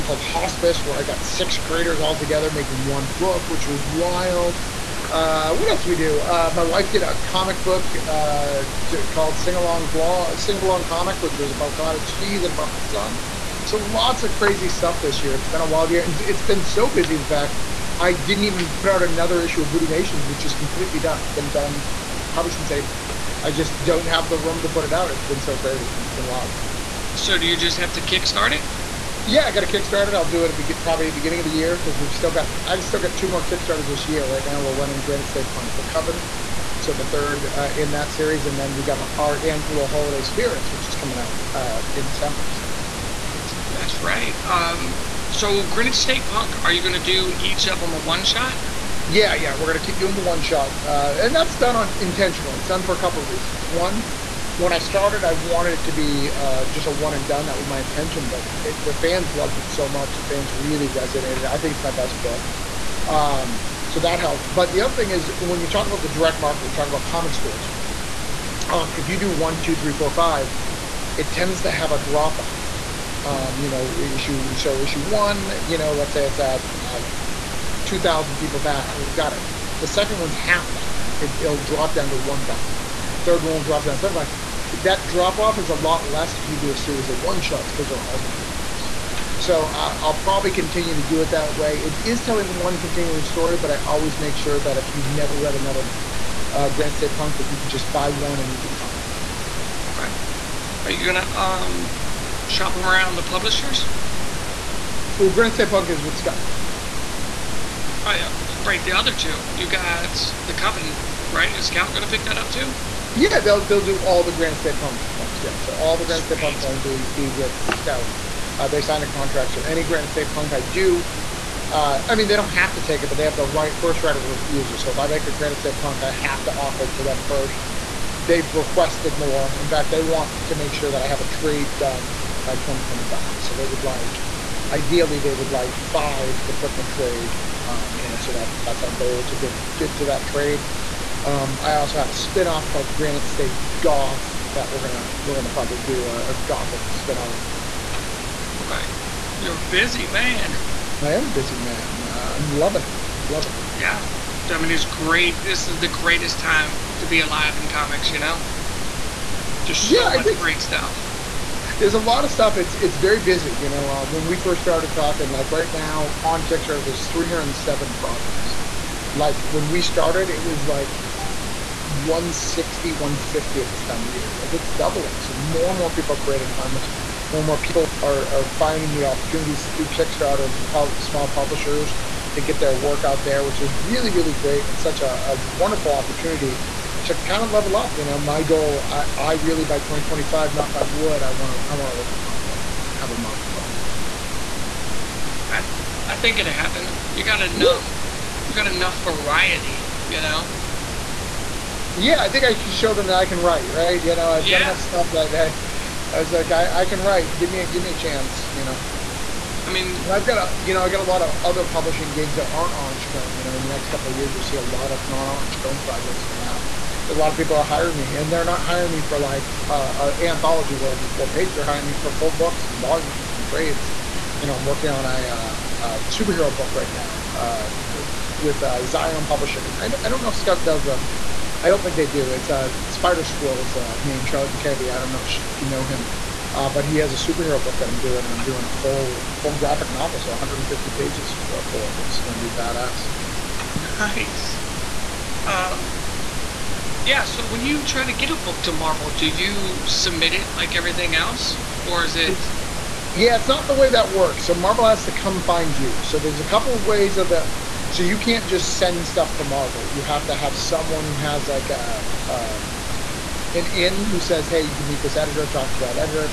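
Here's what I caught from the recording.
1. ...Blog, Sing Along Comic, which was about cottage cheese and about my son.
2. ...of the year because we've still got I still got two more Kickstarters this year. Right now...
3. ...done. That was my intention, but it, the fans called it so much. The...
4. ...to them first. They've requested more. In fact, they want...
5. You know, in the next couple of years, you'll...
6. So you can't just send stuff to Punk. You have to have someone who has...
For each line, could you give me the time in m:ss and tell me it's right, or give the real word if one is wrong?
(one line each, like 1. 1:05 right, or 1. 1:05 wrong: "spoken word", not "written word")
1. 0:09 right
2. 0:31 right
3. 0:57 wrong: "loved", not "called"
4. 2:06 right
5. 3:33 right
6. 4:17 wrong: "Marvel", not "Punk".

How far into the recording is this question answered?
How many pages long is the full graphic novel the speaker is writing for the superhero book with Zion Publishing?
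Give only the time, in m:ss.
4:00.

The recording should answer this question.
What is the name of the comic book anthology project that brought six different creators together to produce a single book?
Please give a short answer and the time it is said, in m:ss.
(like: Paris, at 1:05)
Hospice, at 0:00.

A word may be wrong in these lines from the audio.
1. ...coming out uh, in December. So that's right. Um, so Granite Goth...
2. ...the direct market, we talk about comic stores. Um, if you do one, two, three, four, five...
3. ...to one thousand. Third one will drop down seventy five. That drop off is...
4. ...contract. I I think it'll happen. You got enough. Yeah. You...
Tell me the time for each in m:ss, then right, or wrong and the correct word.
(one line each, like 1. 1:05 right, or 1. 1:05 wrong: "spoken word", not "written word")
1. 0:40 wrong: "State", not "Goth"
2. 1:06 right
3. 1:22 right
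4. 3:13 wrong: "project", not "contract".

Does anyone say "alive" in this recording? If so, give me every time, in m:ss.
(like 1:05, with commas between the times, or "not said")
2:37.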